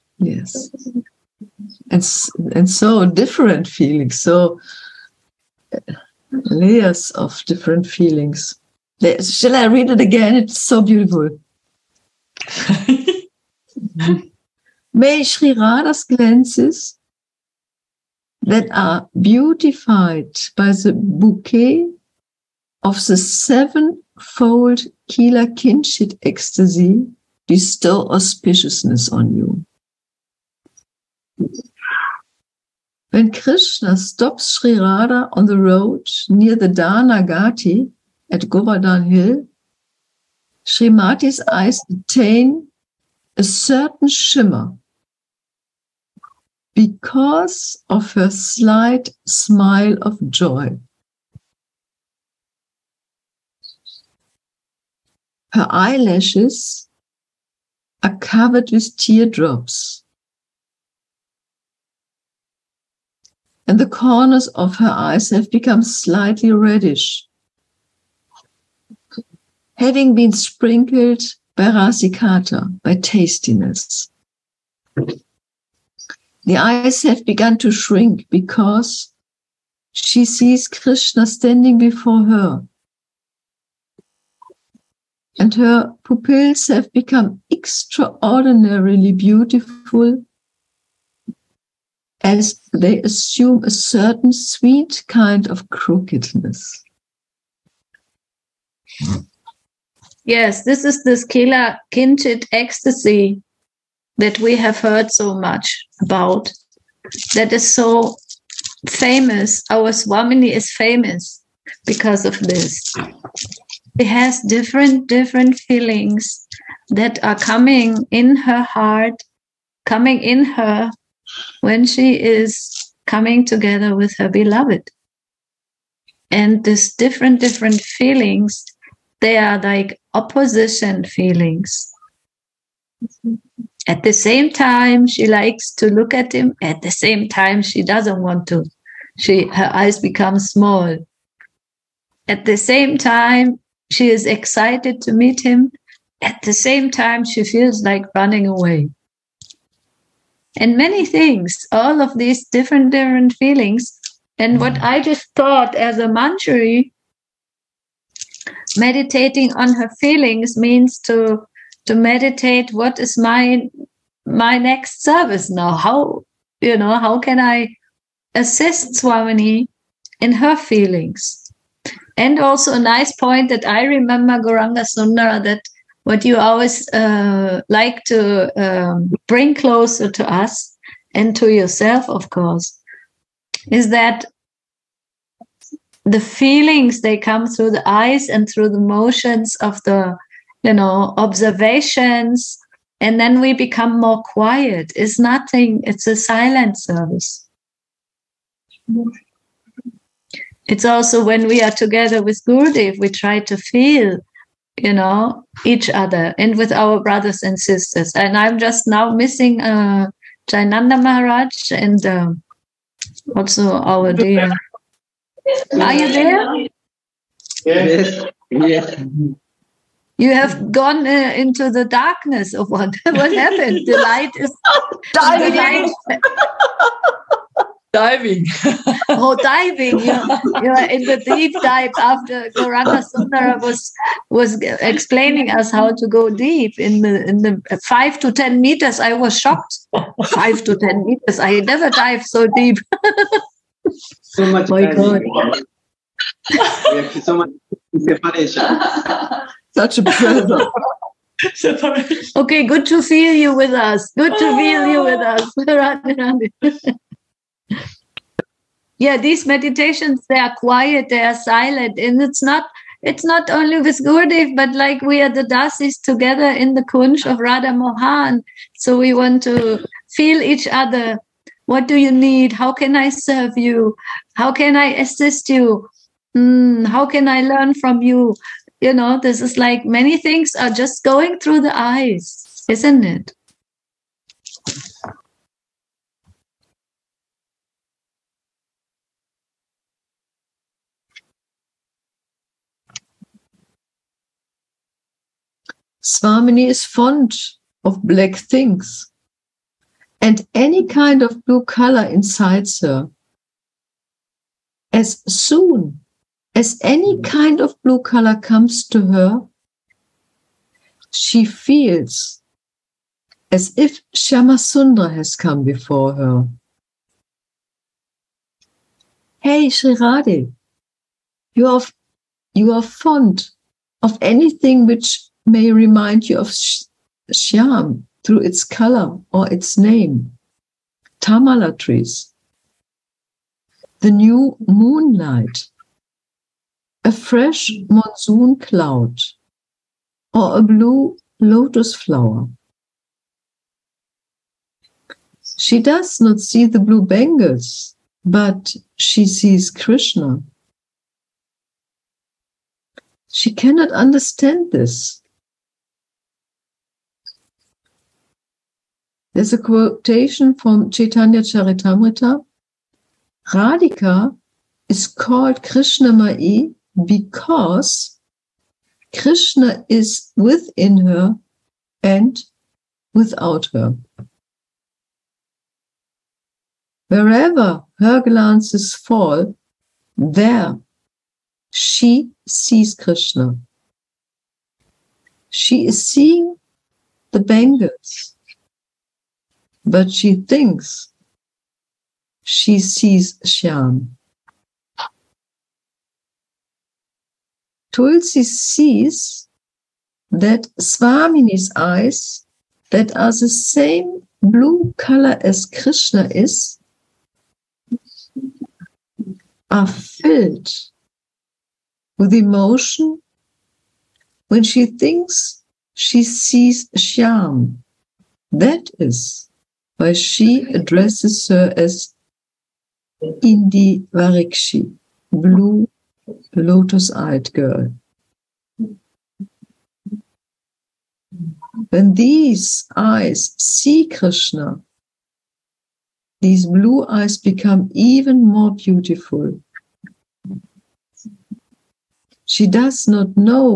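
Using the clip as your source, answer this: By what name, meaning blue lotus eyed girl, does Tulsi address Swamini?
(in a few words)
Indi Varikshi.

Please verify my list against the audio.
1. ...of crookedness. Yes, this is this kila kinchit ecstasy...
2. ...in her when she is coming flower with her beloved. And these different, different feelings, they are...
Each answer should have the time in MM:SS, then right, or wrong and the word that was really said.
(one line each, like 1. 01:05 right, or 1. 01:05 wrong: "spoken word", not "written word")
1. 01:35 right
2. 02:00 wrong: "together", not "flower".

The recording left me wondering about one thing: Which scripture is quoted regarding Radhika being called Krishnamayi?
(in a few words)
Chaitanya Charitamrita.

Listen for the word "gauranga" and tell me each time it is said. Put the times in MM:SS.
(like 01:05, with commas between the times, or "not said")
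02:54, 03:52.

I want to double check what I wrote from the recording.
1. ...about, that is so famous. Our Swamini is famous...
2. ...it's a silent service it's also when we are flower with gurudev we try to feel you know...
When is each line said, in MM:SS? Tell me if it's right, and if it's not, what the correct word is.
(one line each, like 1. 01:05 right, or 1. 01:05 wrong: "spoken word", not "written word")
1. 01:46 right
2. 03:15 wrong: "together", not "flower".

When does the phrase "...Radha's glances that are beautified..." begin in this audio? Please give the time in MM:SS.
00:15.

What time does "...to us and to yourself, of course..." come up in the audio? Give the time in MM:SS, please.
03:00.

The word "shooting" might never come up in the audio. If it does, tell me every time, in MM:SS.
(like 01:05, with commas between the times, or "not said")
not said.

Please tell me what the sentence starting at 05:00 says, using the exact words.
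And any kind of blue color incites her.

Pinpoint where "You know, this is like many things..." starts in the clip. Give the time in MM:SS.
04:38.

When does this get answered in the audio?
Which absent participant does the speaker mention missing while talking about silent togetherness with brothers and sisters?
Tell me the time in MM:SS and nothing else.
03:30.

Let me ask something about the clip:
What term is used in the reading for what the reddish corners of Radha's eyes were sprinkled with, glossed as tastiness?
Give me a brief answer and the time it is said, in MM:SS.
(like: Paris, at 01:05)
rasikata, at 01:11.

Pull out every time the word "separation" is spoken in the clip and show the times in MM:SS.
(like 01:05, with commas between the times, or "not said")
04:08.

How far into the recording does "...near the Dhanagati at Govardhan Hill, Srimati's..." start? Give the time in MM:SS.
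00:36.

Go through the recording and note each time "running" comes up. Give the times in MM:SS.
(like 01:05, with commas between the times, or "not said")
02:28.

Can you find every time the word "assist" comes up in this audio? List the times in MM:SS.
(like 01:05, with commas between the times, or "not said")
02:48, 04:34.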